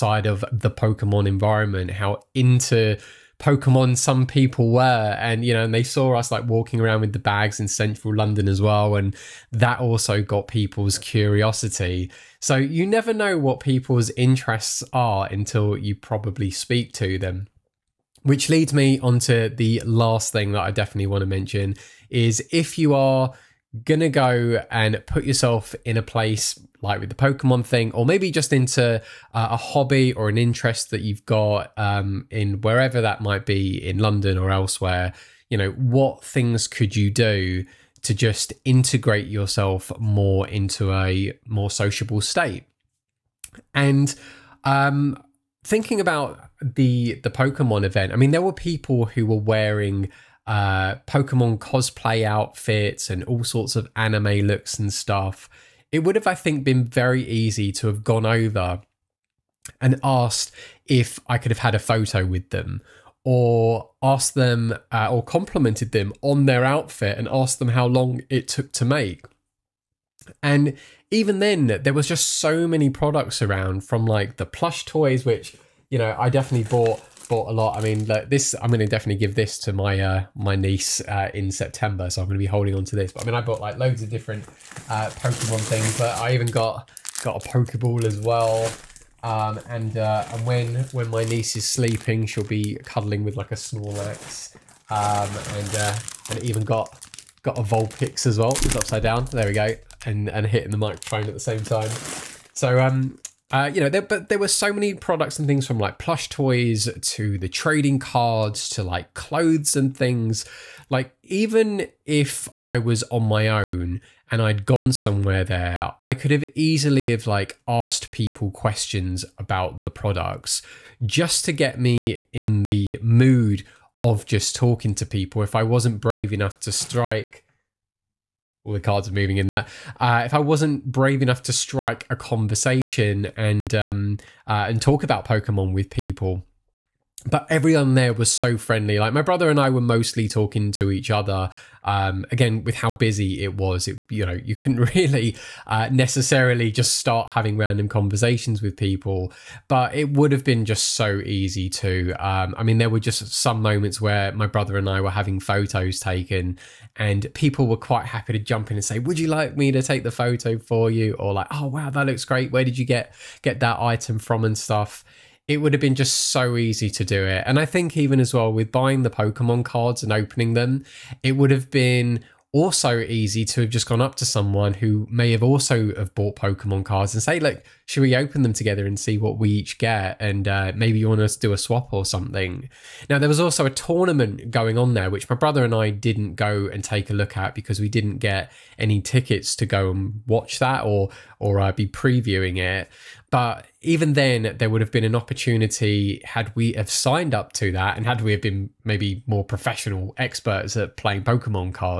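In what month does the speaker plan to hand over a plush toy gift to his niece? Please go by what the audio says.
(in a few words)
September.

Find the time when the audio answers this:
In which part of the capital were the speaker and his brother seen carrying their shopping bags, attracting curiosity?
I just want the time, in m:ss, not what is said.
0:07.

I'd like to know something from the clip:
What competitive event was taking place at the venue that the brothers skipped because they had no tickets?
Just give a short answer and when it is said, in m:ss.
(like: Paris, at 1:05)
a tournament, at 3:03.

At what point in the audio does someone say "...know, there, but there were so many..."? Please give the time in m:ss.
1:43.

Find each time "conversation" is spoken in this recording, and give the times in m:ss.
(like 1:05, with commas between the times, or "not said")
2:12, 2:27.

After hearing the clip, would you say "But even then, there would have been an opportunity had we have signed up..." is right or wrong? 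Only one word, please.
right.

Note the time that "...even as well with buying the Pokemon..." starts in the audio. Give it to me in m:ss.
2:47.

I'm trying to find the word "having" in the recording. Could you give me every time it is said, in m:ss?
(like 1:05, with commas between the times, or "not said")
2:27, 2:35.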